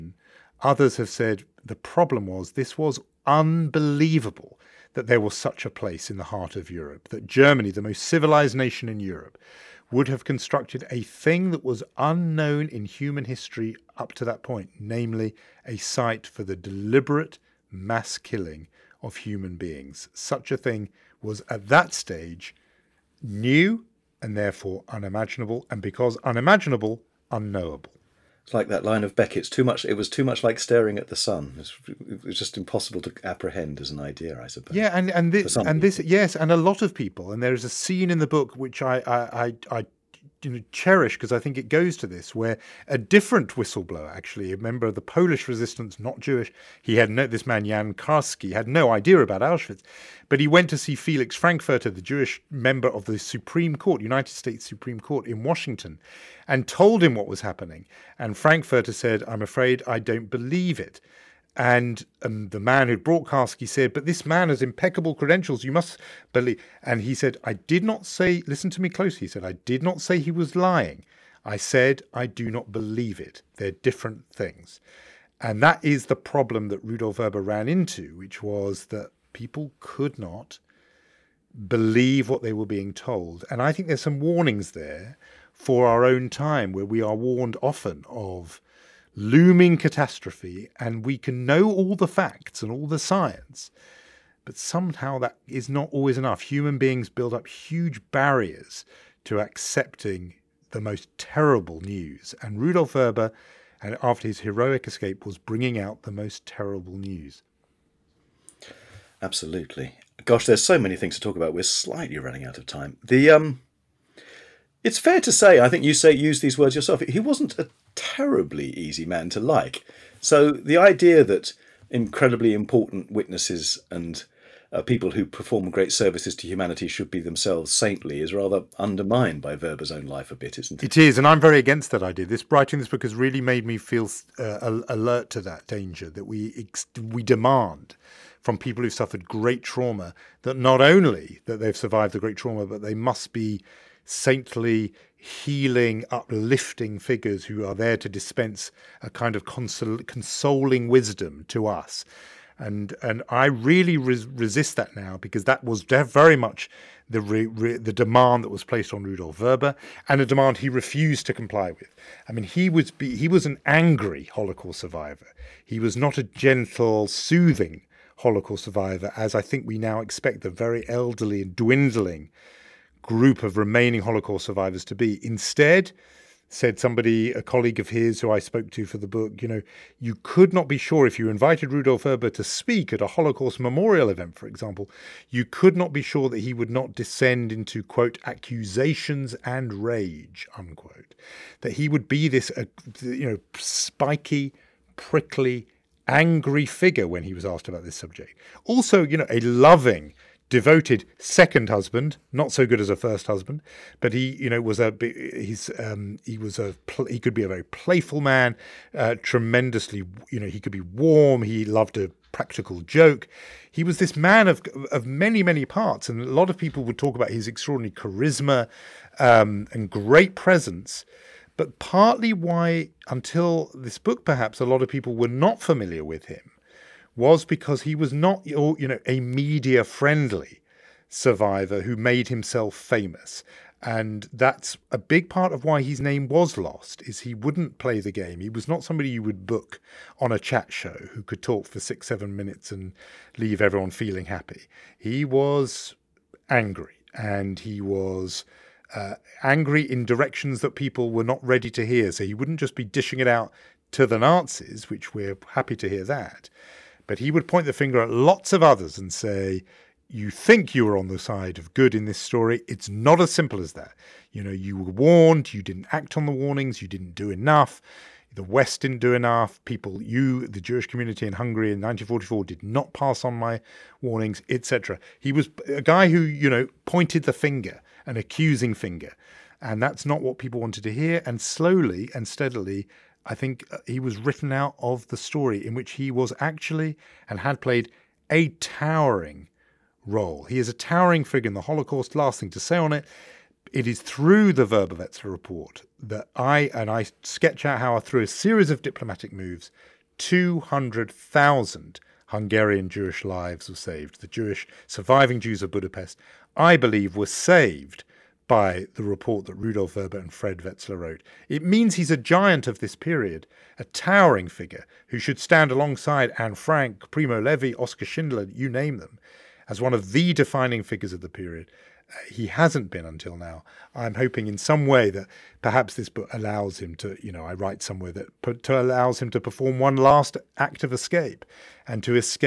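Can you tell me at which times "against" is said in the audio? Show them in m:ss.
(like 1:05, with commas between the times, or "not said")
2:11.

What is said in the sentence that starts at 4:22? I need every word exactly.
It's not as simple as that.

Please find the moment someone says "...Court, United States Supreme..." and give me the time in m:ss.
0:53.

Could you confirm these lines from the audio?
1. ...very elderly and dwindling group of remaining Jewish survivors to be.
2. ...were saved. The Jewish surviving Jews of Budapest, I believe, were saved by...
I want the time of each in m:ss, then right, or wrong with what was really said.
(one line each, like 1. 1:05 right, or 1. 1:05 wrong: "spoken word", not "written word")
1. 2:50 wrong: "Holocaust", not "Jewish"
2. 5:03 right.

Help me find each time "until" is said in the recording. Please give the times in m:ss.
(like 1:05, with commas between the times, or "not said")
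3:43, 5:23.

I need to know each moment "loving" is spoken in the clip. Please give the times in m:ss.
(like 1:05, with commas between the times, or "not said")
3:19.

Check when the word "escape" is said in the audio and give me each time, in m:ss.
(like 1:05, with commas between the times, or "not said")
1:44, 5:30.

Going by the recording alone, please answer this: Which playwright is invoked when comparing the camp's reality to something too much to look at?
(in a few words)
Beckett.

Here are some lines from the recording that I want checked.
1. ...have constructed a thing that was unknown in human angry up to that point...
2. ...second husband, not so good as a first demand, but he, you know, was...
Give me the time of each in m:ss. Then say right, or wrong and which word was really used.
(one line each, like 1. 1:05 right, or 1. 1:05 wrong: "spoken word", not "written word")
1. 0:10 wrong: "history", not "angry"
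2. 3:21 wrong: "husband", not "demand".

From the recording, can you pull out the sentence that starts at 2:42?
I mean, he was he was an angry Holocaust survivor.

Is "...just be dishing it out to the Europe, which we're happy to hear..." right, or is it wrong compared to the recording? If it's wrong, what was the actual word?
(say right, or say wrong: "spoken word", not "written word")
wrong: "Nazis", not "Europe".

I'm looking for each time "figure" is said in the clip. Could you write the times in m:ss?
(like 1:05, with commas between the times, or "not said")
2:26, 3:16, 4:51, 5:14, 5:20.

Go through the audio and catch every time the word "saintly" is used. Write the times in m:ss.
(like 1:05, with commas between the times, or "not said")
2:07, 2:24.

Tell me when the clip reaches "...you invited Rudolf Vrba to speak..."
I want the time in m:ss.
3:01.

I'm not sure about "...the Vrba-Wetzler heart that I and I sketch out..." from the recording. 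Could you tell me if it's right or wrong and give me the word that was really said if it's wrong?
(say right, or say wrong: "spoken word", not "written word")
wrong: "report", not "heart".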